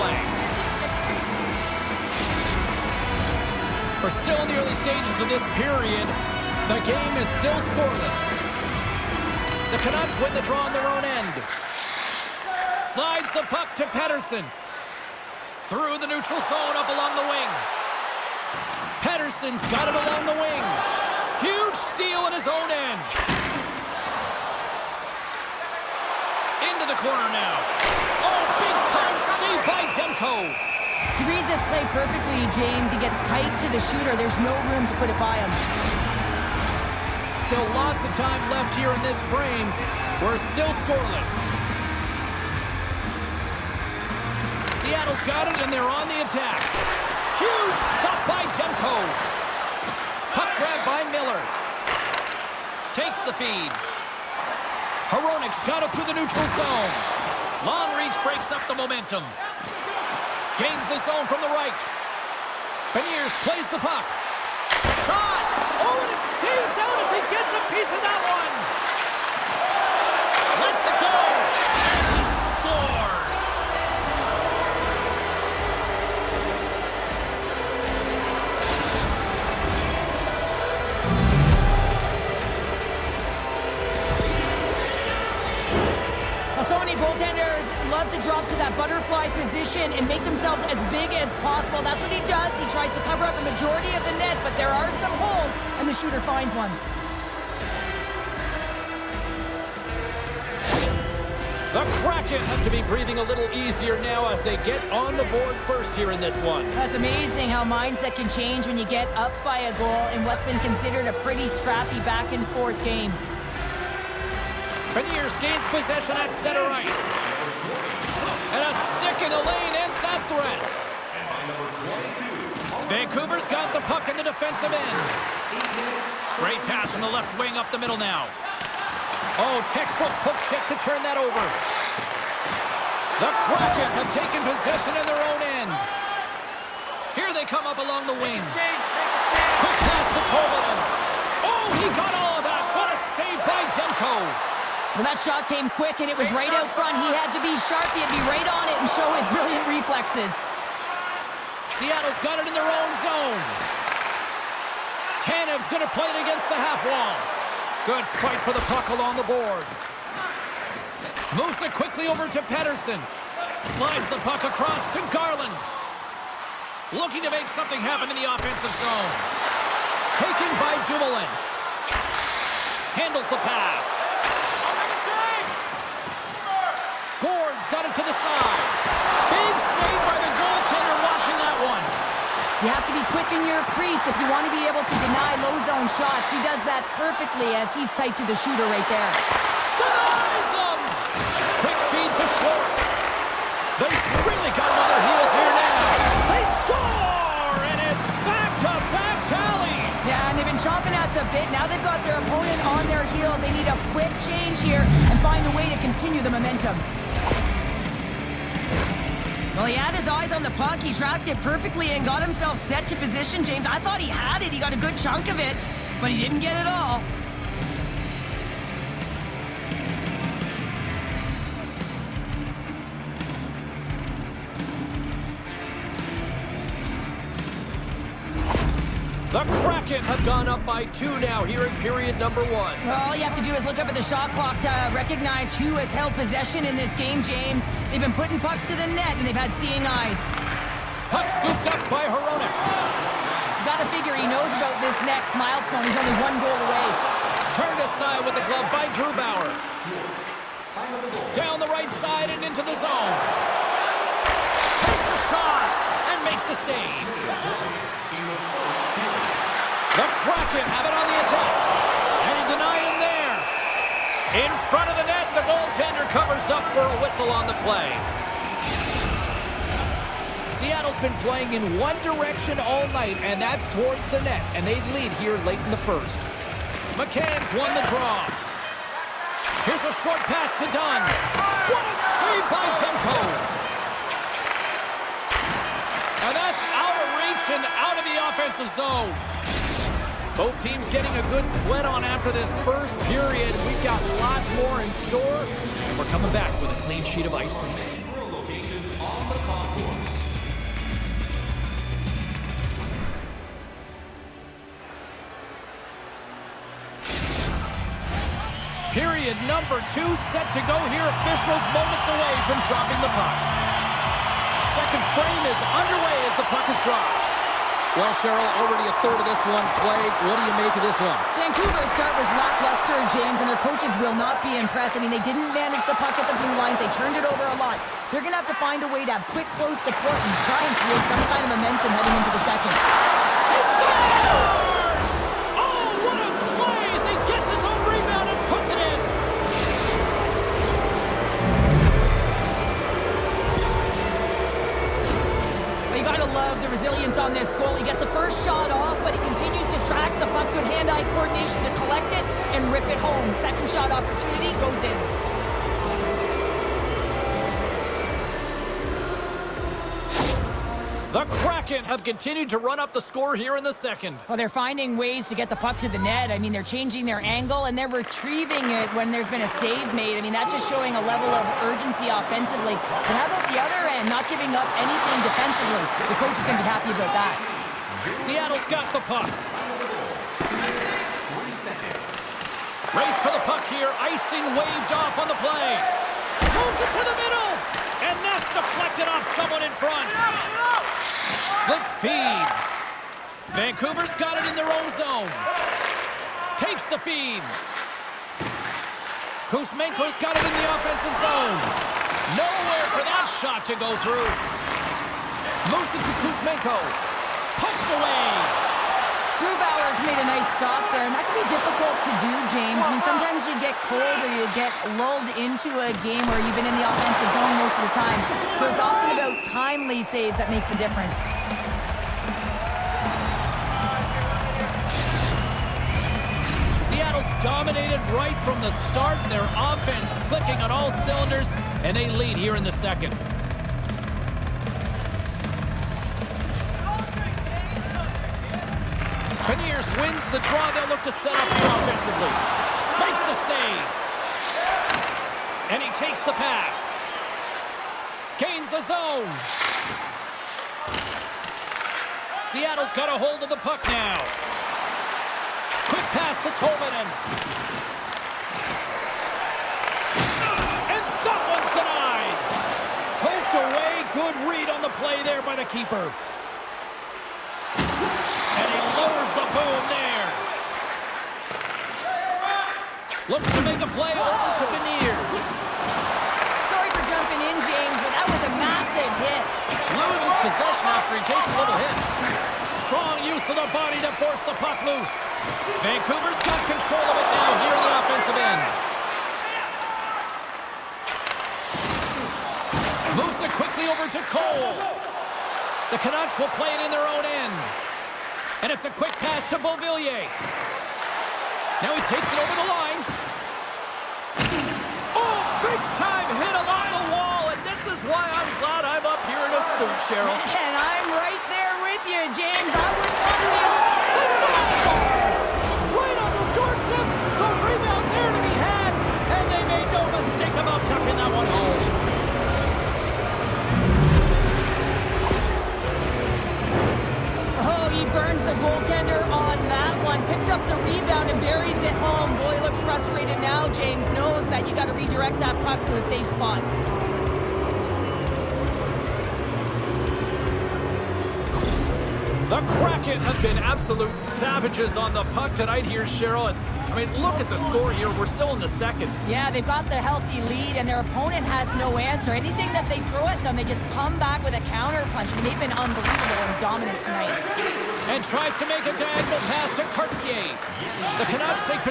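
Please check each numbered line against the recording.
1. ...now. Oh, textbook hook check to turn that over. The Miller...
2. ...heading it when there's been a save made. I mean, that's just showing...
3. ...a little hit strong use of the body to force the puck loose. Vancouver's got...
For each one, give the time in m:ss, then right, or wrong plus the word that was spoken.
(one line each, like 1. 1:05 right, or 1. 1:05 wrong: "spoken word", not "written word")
1. 2:08 wrong: "Kraken", not "Miller"
2. 6:07 wrong: "retrieving", not "heading"
3. 8:01 right.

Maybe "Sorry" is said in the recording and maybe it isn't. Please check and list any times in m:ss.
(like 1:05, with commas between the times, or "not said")
7:56.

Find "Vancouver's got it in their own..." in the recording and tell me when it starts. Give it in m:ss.
6:33.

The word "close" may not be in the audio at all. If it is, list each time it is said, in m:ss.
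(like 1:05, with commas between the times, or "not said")
5:29.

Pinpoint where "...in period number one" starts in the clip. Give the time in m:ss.
3:51.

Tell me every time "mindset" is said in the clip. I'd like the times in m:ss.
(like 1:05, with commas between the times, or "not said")
1:47.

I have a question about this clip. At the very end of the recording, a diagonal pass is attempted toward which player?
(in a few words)
Cartier.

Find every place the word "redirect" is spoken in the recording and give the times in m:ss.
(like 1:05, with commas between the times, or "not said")
8:54.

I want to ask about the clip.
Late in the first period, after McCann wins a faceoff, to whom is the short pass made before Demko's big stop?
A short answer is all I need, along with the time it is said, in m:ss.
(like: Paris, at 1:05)
Dunn, at 4:39.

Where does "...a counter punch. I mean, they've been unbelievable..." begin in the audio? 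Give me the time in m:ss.
9:14.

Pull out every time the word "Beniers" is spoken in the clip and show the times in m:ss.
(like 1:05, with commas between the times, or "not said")
1:02, 1:54, 7:19, 7:54.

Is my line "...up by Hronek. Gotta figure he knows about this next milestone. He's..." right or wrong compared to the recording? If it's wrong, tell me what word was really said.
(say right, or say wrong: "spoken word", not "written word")
right.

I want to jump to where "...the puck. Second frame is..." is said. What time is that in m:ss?
5:13.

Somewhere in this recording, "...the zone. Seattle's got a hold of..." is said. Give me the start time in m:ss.
7:28.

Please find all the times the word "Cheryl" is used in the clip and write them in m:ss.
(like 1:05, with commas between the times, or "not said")
5:18, 8:30, 9:06.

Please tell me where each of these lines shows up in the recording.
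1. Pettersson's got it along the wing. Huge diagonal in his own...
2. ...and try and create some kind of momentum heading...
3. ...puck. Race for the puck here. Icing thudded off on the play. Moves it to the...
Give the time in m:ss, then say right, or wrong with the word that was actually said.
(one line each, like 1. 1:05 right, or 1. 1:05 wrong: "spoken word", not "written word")
1. 0:19 wrong: "steal", not "diagonal"
2. 5:30 right
3. 6:19 wrong: "waved", not "thudded".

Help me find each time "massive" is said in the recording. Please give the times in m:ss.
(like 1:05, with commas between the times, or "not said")
7:58.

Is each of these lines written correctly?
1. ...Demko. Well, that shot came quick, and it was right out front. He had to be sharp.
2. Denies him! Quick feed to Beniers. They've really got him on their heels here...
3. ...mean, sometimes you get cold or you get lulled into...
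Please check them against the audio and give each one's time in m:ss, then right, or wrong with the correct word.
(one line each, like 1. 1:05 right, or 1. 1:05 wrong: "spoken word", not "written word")
1. 2:23 right
2. 3:09 wrong: "Schwartz", not "Beniers"
3. 6:52 right.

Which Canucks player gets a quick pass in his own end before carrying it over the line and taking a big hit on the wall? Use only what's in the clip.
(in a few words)
Beauvillier.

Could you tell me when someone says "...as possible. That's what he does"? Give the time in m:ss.
1:31.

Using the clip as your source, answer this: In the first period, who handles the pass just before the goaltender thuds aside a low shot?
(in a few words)
Dumoulin.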